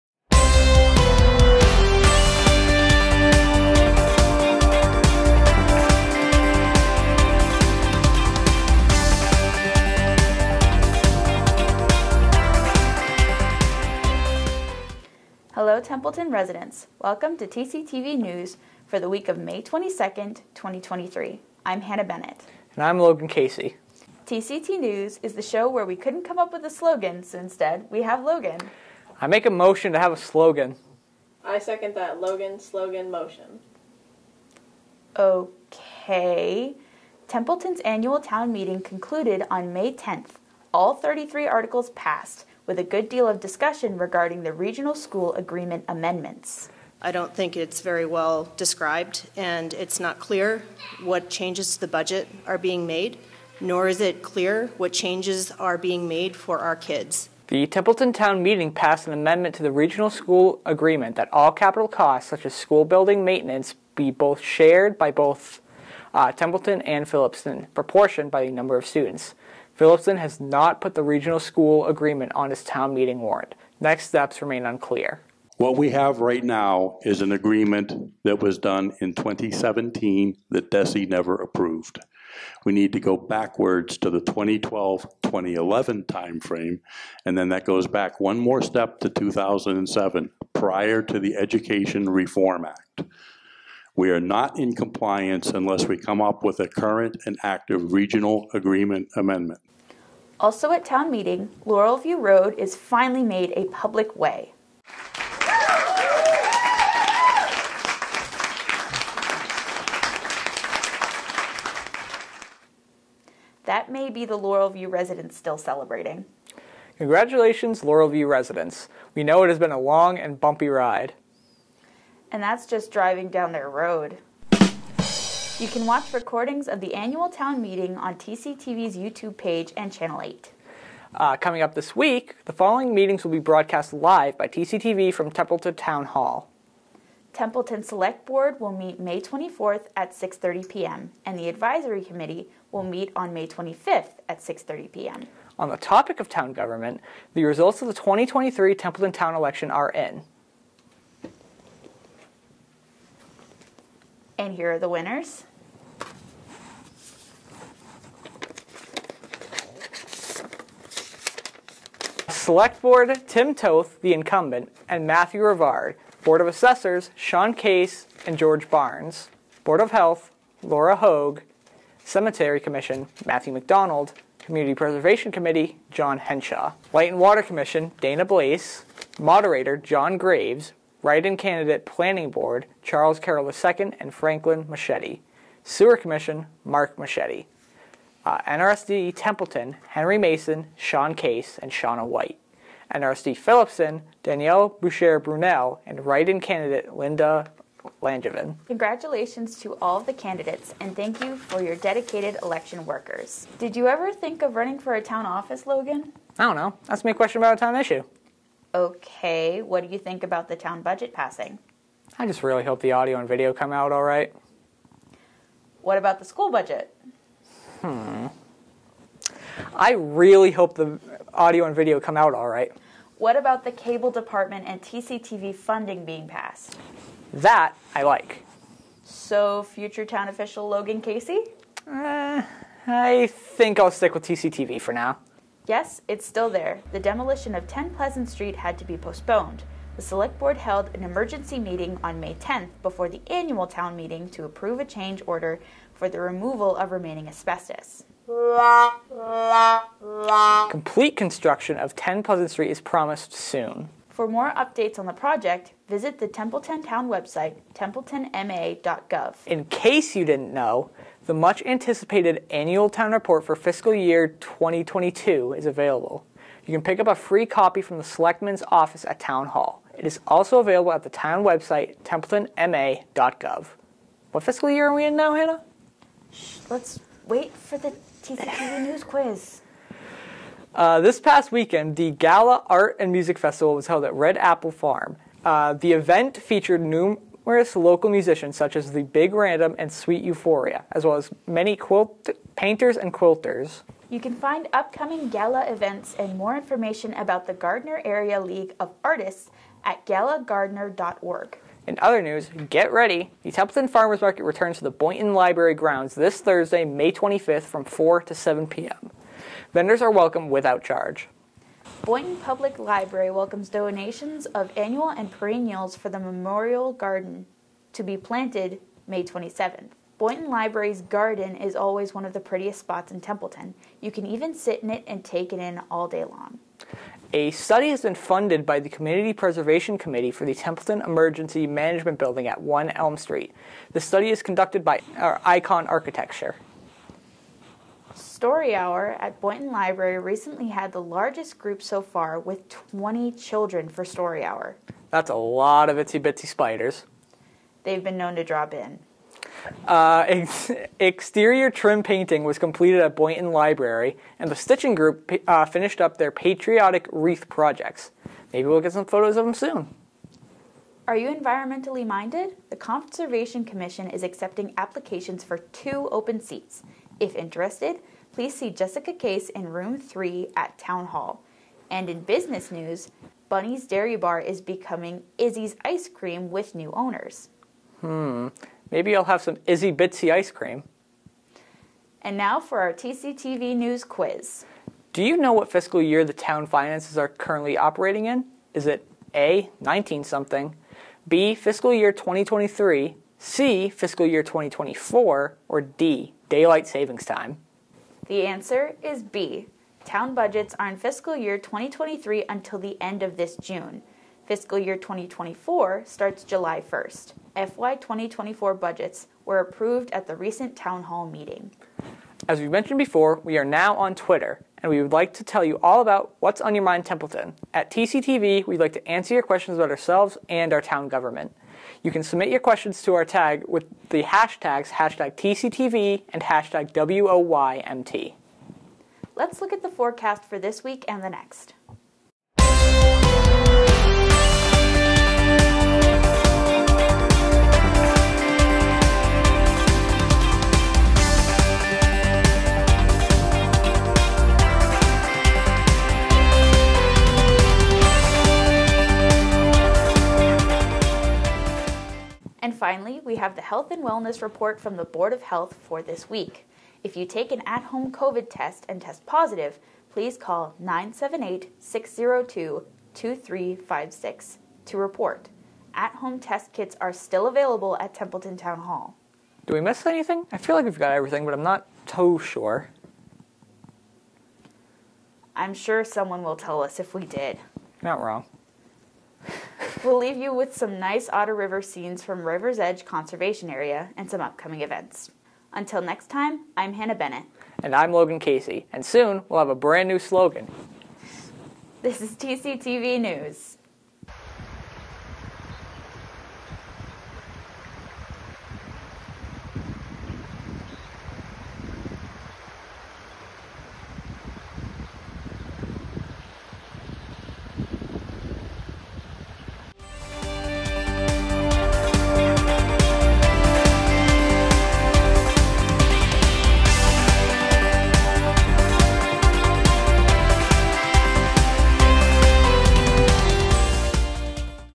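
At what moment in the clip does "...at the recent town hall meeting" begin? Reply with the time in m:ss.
6:50.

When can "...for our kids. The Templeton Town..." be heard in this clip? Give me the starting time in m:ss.
0:56.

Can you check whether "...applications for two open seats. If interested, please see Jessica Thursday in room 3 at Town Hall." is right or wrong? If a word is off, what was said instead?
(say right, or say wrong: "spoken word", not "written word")
wrong: "Case", not "Thursday".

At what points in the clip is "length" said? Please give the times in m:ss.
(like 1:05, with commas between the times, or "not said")
not said.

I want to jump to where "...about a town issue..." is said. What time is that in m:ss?
3:27.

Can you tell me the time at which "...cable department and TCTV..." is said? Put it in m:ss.
3:43.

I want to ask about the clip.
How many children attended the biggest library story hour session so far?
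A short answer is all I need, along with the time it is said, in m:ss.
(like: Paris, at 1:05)
20, at 5:42.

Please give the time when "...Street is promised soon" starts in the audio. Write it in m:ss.
4:12.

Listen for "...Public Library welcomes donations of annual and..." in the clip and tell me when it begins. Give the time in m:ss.
5:12.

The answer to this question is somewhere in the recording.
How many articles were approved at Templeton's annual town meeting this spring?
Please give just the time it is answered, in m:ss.
0:40.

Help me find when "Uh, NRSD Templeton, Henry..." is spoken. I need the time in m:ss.
3:08.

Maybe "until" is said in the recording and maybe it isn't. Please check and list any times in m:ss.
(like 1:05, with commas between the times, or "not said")
6:42, 8:05.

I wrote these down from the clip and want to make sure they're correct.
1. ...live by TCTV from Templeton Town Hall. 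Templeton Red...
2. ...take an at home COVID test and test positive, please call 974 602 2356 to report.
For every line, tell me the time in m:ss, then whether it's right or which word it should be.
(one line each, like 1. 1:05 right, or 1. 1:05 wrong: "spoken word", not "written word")
1. 2:13 wrong: "Select", not "Red"
2. 7:37 wrong: "978", not "974".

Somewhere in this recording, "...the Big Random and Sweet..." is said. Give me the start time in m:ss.
4:48.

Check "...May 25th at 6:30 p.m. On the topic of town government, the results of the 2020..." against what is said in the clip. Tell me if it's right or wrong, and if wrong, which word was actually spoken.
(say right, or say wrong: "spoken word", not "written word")
wrong: "2023", not "2020".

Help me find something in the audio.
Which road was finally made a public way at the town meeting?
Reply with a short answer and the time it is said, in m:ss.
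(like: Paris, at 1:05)
Laurel View Road, at 1:41.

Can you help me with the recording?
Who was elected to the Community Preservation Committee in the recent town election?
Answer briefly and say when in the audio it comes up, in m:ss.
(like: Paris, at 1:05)
John Henshaw, at 2:55.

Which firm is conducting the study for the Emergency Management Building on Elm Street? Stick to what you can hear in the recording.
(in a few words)
Icon Architecture.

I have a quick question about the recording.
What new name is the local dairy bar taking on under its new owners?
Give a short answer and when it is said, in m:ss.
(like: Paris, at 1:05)
Izzy's Ice Cream, at 6:15.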